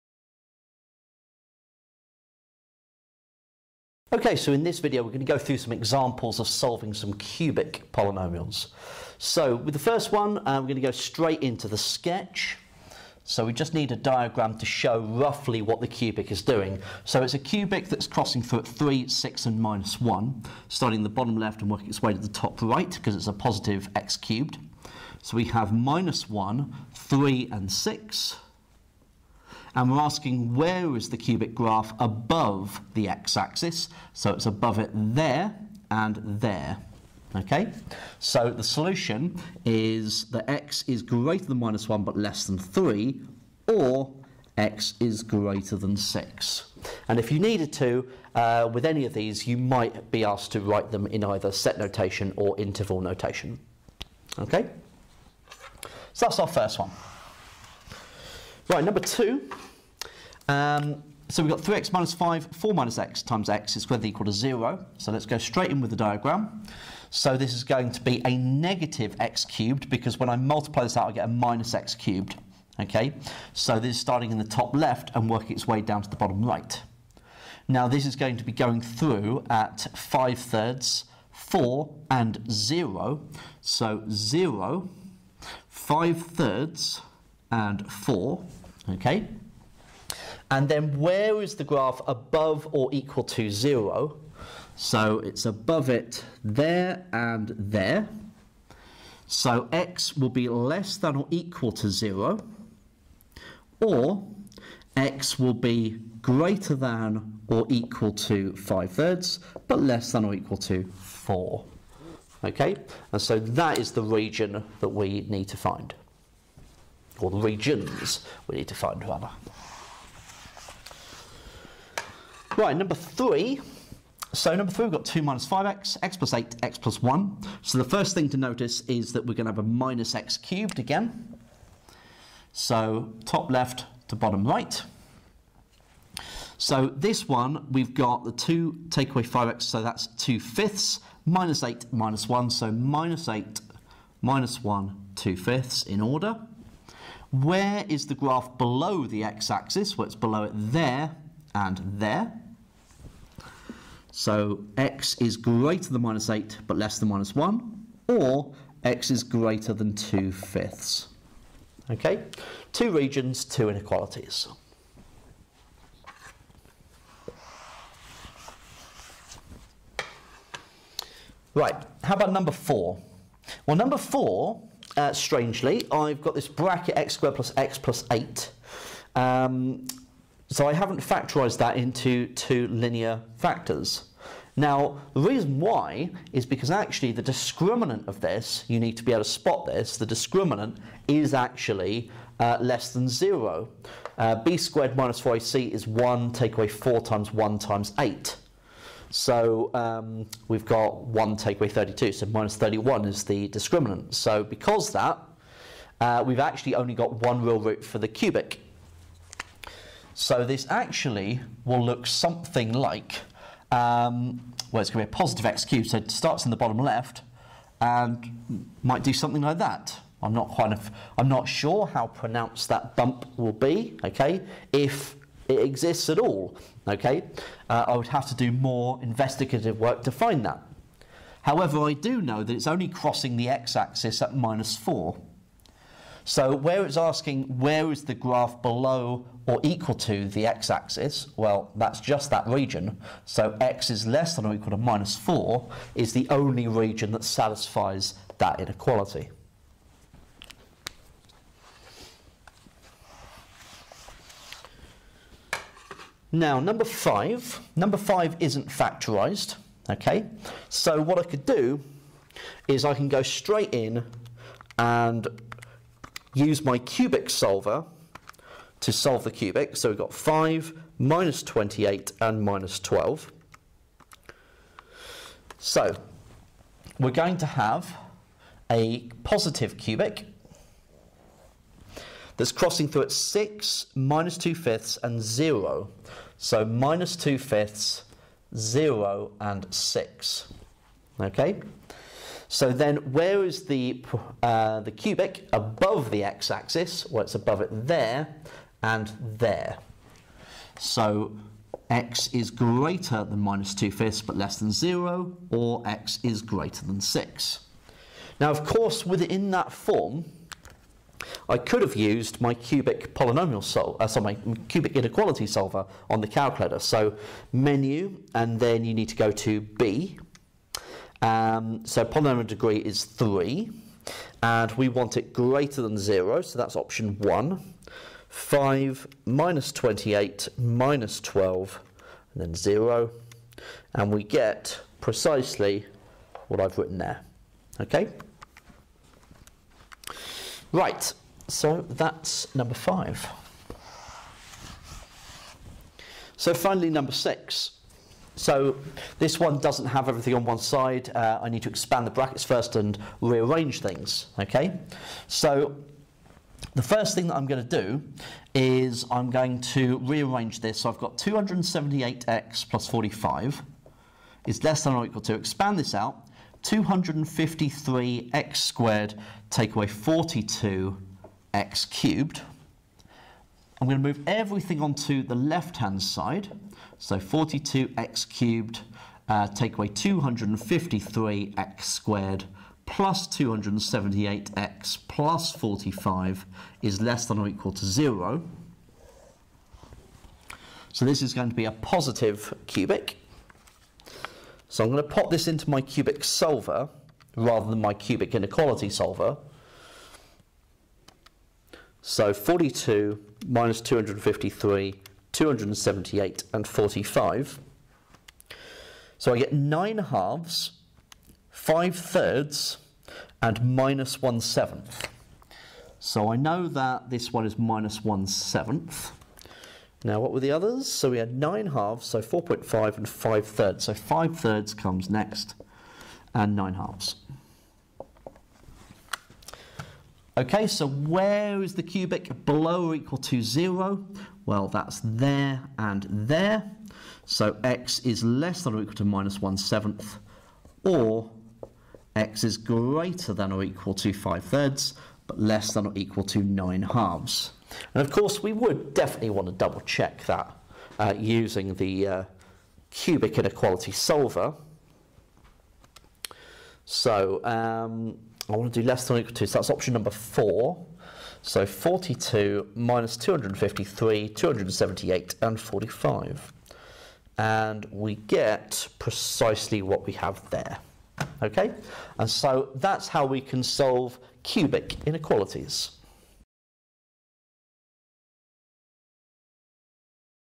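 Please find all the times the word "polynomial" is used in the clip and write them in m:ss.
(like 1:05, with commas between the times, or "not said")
0:07, 5:13, 5:22.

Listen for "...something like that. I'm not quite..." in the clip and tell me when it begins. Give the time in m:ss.
3:39.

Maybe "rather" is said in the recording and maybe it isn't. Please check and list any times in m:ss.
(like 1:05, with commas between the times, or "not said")
1:59, 6:37.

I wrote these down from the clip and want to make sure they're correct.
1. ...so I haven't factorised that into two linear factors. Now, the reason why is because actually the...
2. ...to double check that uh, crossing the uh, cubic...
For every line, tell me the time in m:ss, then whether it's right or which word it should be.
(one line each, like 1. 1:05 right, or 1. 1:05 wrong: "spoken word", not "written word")
1. 3:00 right
2. 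7:29 wrong: "using", not "crossing".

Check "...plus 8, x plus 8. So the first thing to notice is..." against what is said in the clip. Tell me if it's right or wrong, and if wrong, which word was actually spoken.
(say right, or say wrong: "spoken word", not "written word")
wrong: "1", not "8".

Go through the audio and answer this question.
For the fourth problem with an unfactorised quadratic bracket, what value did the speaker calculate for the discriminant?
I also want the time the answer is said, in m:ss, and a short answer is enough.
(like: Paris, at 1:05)
-31, at 3:22.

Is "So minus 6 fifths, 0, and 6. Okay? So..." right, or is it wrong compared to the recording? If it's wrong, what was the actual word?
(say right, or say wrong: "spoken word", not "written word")
wrong: "2", not "6".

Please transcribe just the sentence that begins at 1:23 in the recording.
So 0, 5 thirds and 4 Okay?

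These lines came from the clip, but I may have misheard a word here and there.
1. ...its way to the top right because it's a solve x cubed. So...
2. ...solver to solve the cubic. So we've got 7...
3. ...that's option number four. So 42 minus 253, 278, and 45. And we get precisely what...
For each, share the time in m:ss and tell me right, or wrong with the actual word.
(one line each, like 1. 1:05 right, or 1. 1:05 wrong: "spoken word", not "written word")
1. 0:21 wrong: "positive", not "solve"
2. 4:27 wrong: "5", not "7"
3. 7:39 right.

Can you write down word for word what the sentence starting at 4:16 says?
Now, number five, number five isn't factorized, okay?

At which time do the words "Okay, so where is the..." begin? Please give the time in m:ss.
7:10.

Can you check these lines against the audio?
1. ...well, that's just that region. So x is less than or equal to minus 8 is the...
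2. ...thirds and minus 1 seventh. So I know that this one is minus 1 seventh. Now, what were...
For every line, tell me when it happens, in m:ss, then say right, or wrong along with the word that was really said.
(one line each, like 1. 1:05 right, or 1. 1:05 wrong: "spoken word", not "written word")
1. 4:01 wrong: "4", not "8"
2. 6:51 right.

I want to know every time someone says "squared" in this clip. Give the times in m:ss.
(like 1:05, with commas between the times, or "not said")
1:03, 2:57, 3:14, 6:08, 6:21.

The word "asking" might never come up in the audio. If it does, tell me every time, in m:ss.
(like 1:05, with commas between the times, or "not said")
0:29, 3:56.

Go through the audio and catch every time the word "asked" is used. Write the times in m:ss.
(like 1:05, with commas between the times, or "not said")
0:50.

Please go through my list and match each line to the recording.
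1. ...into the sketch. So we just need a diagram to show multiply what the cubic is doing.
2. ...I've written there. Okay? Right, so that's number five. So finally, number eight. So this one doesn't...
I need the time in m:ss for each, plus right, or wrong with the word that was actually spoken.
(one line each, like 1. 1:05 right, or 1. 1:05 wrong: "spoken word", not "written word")
1. 0:11 wrong: "roughly", not "multiply"
2. 5:36 wrong: "six", not "eight".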